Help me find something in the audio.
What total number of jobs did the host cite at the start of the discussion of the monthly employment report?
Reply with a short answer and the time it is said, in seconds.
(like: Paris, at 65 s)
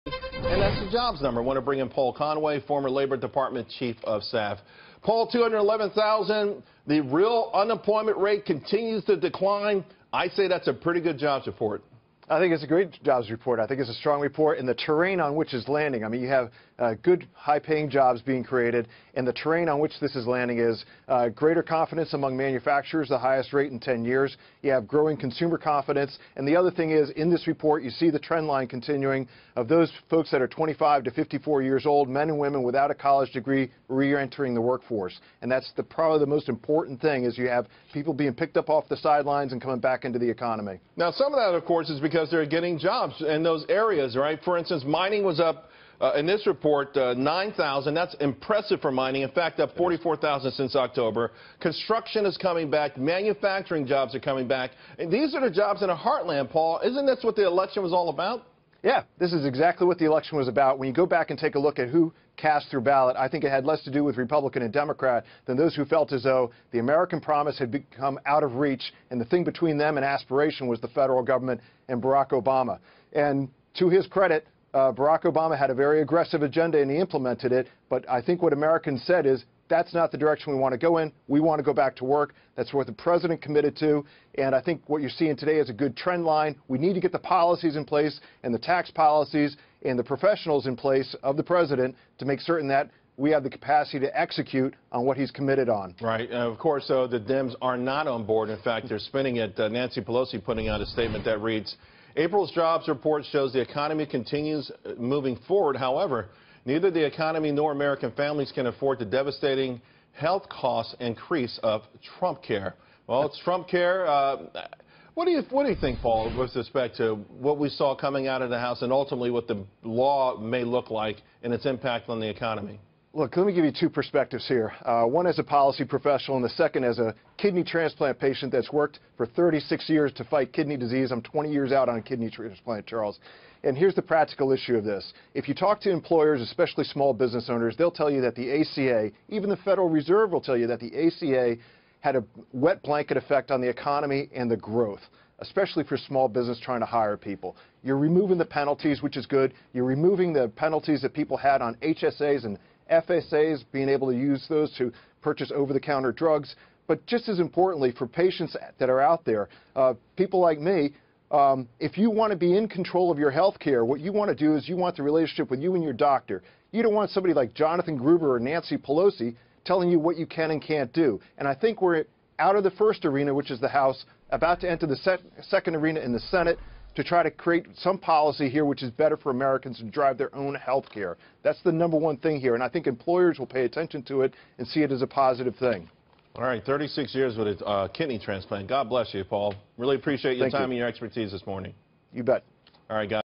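211,000, at 5 s.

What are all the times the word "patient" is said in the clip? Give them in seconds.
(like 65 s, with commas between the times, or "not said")
128 s, 158 s.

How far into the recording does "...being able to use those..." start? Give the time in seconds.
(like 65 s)
153 s.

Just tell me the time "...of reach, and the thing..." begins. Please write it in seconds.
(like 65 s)
68 s.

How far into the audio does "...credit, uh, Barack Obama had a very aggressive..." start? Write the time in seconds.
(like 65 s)
74 s.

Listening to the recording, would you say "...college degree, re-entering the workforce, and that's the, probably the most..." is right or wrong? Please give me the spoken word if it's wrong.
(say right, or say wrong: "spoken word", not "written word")
right.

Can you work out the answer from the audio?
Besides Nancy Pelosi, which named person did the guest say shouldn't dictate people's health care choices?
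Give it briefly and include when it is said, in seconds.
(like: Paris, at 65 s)
Jonathan Gruber, at 167 s.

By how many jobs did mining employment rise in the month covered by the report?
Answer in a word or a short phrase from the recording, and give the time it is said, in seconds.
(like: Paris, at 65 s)
9,000, at 47 s.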